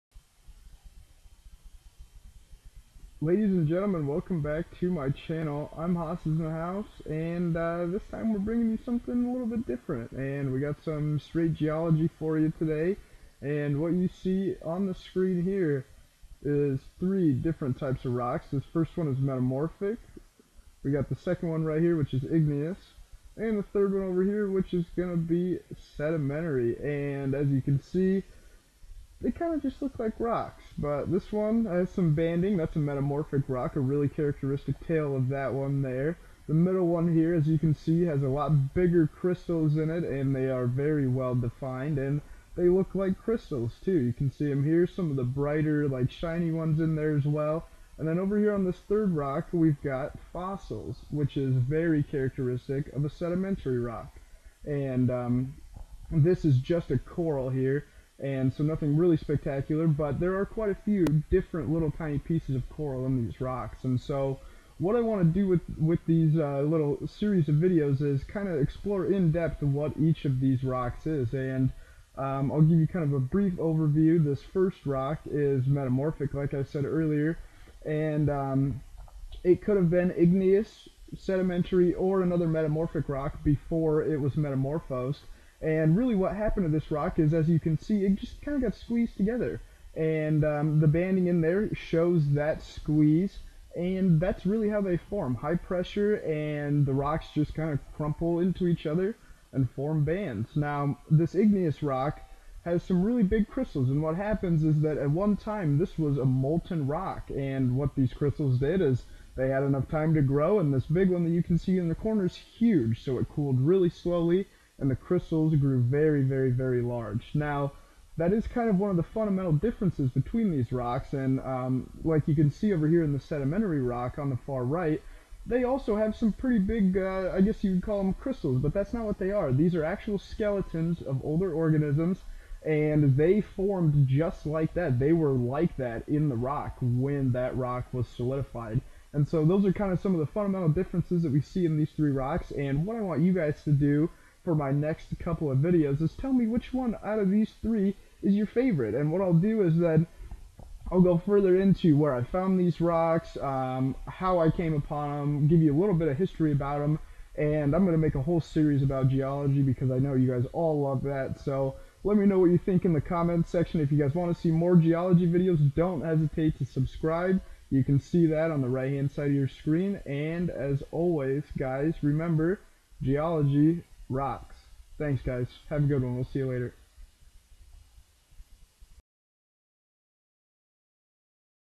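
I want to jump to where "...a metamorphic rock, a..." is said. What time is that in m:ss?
0:32.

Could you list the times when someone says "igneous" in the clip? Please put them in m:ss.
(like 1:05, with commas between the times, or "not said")
0:22, 1:20, 1:41.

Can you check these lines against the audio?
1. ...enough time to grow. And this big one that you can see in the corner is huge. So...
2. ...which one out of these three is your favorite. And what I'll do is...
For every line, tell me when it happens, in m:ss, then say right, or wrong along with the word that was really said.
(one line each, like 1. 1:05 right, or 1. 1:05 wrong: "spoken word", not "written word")
1. 1:49 right
2. 2:26 right.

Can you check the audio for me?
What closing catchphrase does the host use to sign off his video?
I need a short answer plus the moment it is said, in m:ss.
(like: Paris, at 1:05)
Geology rocks, at 2:53.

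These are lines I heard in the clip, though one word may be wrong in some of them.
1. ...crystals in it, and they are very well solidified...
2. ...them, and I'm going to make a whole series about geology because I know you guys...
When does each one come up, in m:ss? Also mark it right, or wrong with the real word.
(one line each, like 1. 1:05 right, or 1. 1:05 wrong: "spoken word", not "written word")
1. 0:39 wrong: "defined", not "solidified"
2. 2:36 right.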